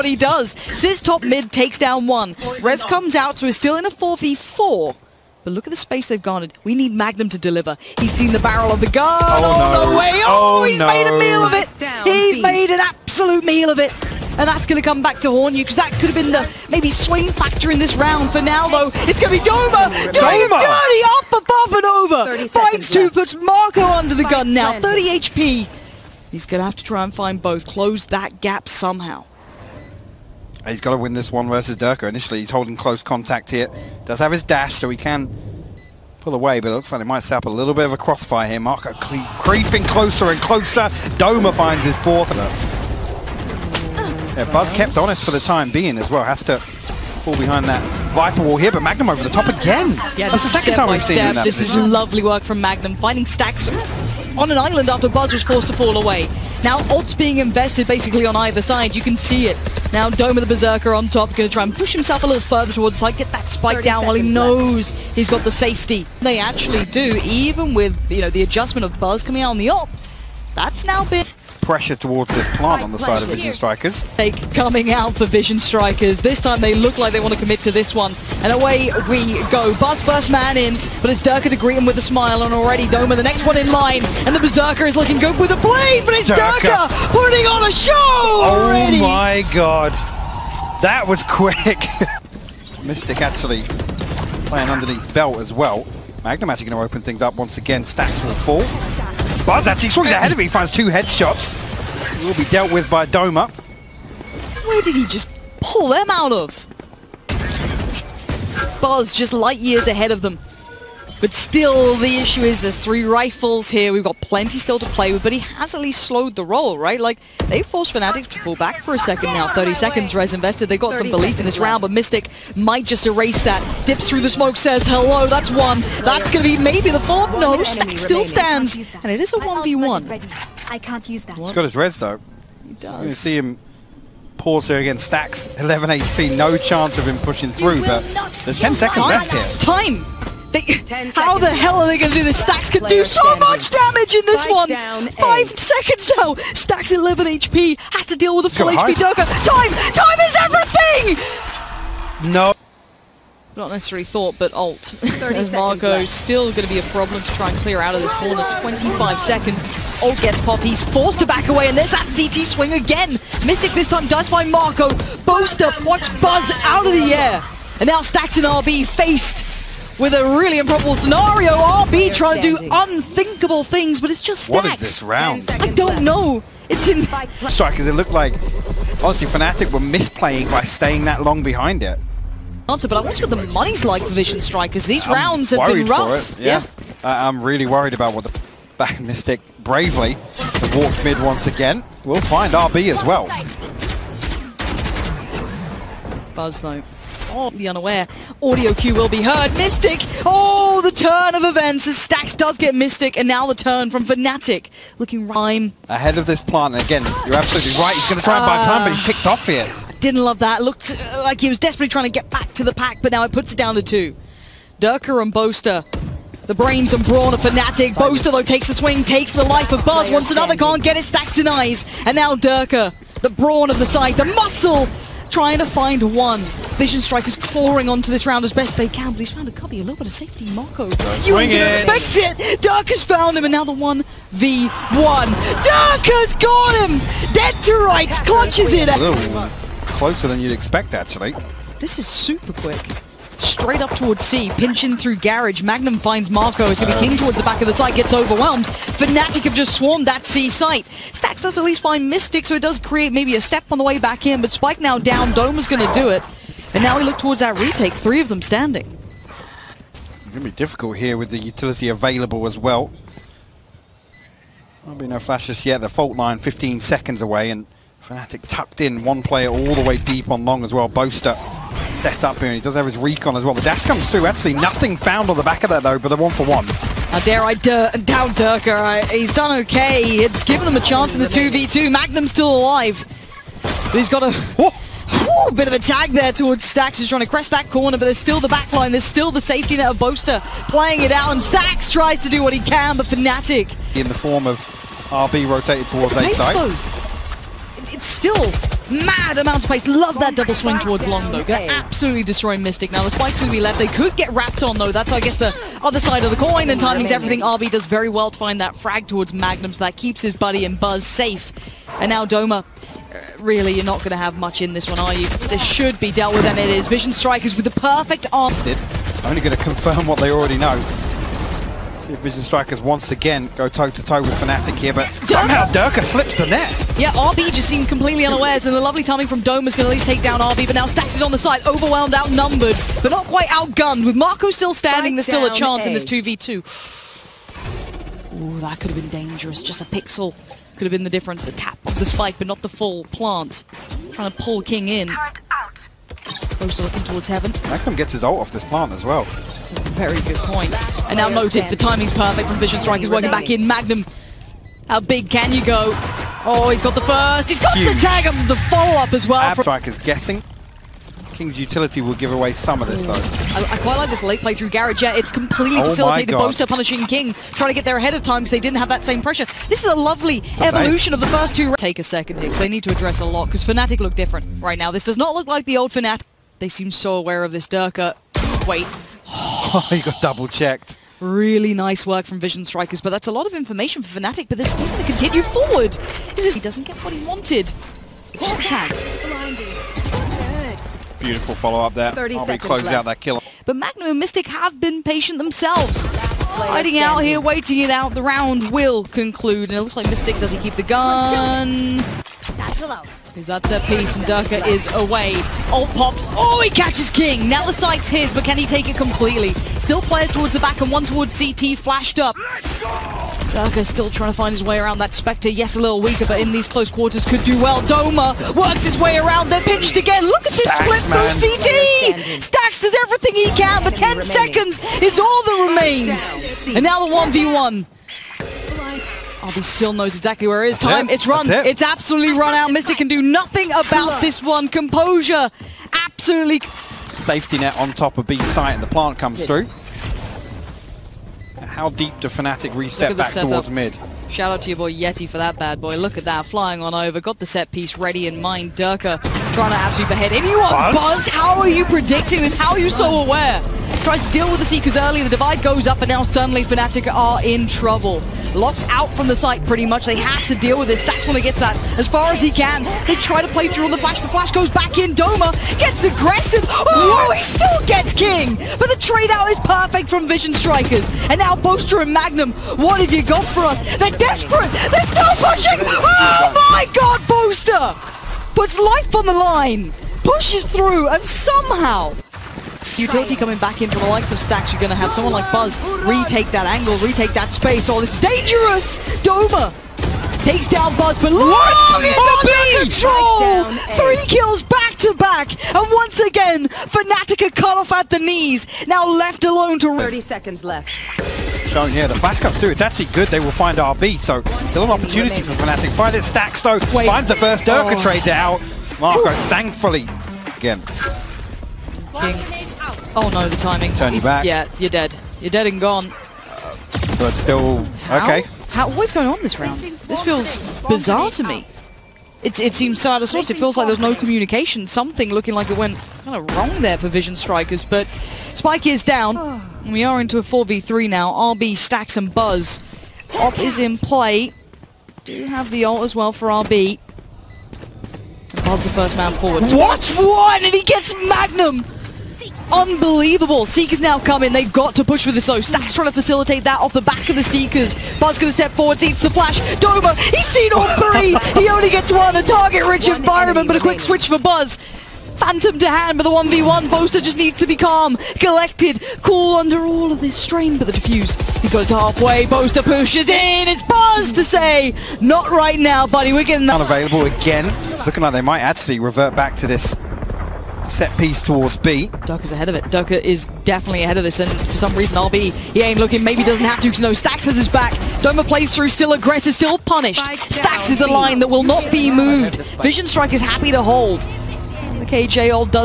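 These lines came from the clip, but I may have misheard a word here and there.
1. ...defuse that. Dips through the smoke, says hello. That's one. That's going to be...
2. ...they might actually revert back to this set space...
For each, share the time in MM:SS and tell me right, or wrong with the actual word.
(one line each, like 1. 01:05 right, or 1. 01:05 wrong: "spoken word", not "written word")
1. 02:03 wrong: "erase", not "defuse"
2. 09:28 wrong: "piece", not "space".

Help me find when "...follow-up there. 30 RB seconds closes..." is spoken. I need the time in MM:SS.
06:31.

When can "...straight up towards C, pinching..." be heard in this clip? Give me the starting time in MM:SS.
04:03.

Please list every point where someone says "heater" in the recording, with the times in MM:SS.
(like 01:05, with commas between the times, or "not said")
not said.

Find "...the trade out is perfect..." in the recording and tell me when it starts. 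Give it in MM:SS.
07:48.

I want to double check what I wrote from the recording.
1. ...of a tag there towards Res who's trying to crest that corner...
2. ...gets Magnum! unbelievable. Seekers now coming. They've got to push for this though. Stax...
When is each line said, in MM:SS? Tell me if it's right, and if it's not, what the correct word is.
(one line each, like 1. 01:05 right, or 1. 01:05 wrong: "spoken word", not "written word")
1. 04:45 wrong: "Stax", not "Res"
2. 09:00 right.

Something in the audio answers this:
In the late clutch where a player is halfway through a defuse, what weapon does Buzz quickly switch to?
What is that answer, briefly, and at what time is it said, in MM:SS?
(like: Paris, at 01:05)
Phantom, at 09:15.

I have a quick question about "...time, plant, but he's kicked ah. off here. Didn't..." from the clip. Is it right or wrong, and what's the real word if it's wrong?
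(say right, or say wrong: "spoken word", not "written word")
right.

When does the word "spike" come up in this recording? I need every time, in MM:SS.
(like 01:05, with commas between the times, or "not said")
01:03, 02:24, 04:14, 05:03, 05:42, 08:48.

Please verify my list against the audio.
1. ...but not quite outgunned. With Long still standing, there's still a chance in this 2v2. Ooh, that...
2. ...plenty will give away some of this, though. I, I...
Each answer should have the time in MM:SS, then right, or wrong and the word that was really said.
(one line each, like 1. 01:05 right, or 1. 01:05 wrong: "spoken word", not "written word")
1. 05:33 wrong: "MaKo", not "Long"
2. 06:01 wrong: "utility", not "plenty".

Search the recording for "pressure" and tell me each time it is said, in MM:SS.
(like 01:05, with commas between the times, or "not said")
01:11, 06:09.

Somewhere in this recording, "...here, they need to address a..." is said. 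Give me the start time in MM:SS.
06:12.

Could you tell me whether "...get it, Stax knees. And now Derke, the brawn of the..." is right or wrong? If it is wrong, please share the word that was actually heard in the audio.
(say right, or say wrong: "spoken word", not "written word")
wrong: "denies", not "knees".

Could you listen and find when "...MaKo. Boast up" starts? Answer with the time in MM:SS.
02:44.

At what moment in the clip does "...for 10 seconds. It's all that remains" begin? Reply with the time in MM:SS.
07:03.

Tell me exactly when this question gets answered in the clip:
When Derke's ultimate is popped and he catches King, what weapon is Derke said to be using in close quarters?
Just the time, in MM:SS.
06:55.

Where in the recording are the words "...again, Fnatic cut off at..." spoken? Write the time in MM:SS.
08:16.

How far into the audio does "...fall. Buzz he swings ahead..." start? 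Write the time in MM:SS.
01:38.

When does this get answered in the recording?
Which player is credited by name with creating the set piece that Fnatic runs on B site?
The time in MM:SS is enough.
07:24.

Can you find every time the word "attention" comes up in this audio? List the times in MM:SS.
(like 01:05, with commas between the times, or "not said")
not said.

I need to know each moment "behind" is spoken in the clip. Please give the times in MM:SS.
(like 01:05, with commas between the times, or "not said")
00:47, 03:01.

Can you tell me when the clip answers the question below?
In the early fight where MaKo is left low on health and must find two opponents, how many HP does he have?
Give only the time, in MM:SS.
00:24.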